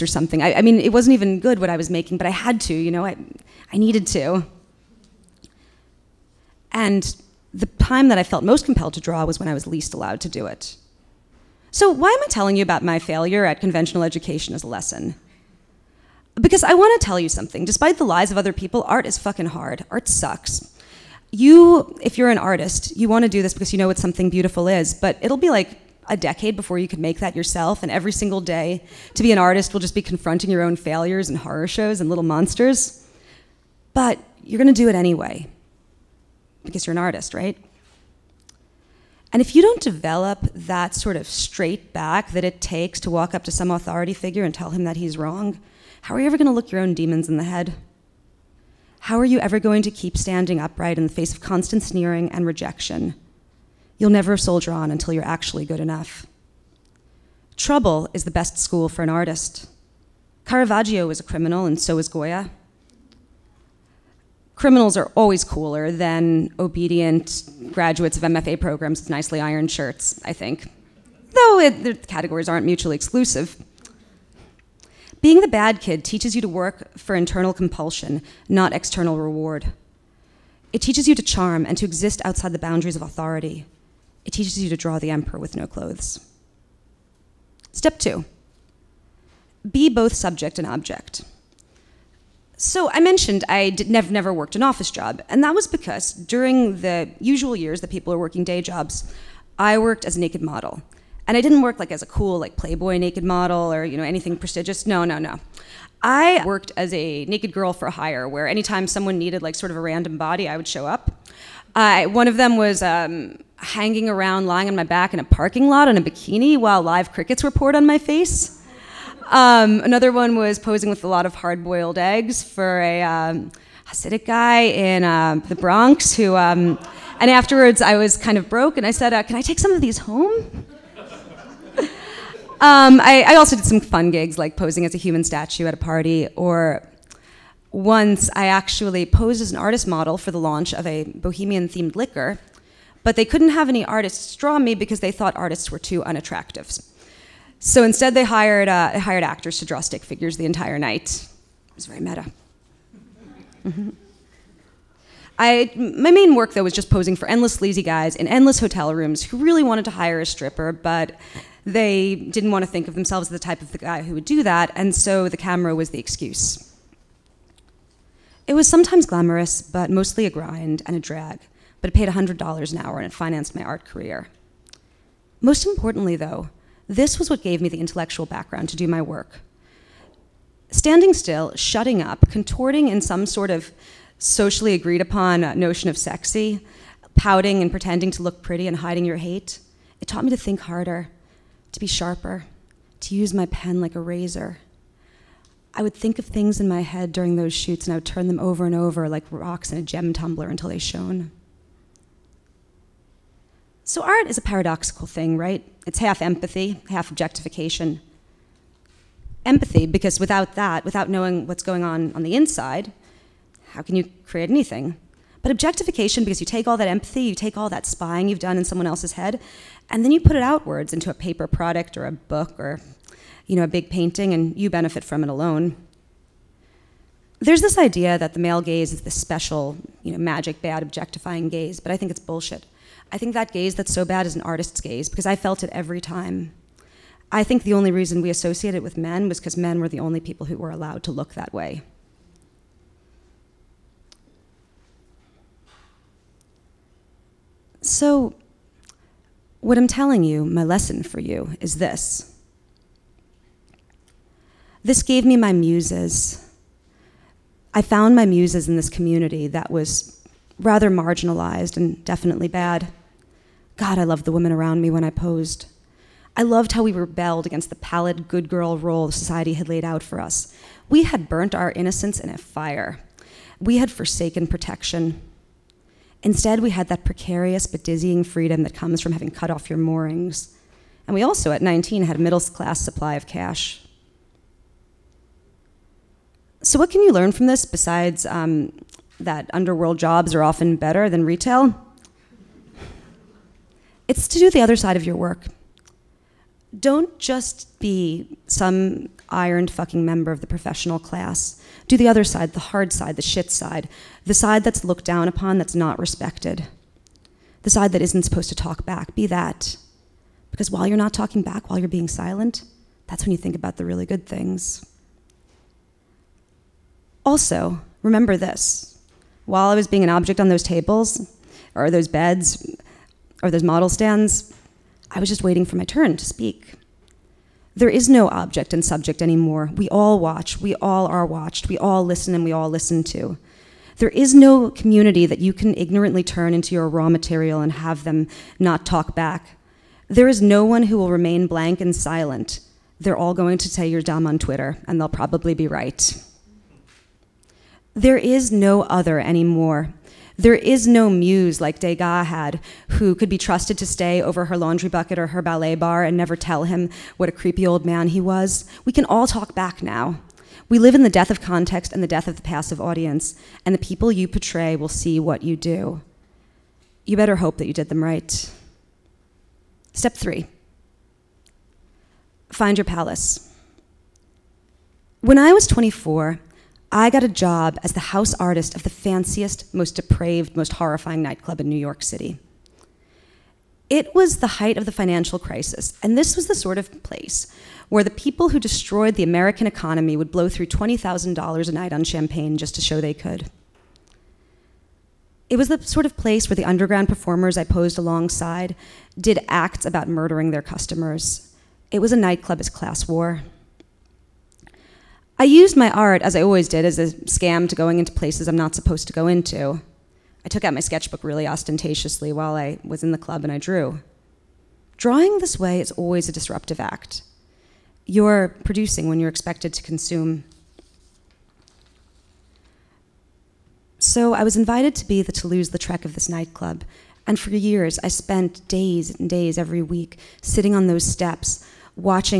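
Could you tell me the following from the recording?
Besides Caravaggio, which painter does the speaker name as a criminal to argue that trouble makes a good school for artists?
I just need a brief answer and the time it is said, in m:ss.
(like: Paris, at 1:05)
Goya, at 1:02.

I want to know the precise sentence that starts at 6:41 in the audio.
It was a nightclub as class war.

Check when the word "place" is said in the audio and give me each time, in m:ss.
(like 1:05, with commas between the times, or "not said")
6:27, 6:36, 6:48.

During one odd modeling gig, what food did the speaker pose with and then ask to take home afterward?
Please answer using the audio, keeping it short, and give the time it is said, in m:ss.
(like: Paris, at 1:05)
hard boiled eggs, at 2:01.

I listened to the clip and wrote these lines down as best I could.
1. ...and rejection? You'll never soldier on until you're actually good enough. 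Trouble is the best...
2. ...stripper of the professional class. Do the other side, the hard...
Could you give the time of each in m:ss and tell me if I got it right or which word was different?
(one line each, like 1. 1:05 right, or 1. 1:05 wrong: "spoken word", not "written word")
1. 0:52 right
2. 5:00 wrong: "member", not "stripper".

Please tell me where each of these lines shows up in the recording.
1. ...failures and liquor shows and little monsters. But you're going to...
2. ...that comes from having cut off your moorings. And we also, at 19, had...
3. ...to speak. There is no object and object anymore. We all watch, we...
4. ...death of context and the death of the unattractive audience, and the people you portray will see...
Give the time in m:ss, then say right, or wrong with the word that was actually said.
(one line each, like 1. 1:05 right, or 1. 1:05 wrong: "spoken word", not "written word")
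1. 0:30 wrong: "horror", not "liquor"
2. 4:38 right
3. 5:26 wrong: "subject", not "object"
4. 6:01 wrong: "passive", not "unattractive".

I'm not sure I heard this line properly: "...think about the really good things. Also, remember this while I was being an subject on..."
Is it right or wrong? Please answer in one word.
wrong.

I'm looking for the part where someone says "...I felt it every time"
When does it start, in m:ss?
3:55.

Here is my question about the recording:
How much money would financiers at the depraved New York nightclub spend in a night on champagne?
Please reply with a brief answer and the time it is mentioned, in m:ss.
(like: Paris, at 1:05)
$20,000, at 6:30.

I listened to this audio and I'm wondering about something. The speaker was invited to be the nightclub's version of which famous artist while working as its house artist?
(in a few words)
Toulouse Lautrec.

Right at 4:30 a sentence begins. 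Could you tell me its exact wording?
We had burnt our innocence in a fire.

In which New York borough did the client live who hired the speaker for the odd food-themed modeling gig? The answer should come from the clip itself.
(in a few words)
the Bronx.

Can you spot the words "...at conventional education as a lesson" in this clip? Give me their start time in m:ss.
0:13.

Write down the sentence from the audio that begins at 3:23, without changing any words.
So art is a paradoxical thing, right?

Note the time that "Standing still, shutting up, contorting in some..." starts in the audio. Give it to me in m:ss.
3:00.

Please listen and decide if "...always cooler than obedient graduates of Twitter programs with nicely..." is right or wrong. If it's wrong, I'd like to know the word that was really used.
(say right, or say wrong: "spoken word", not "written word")
wrong: "MFA", not "Twitter".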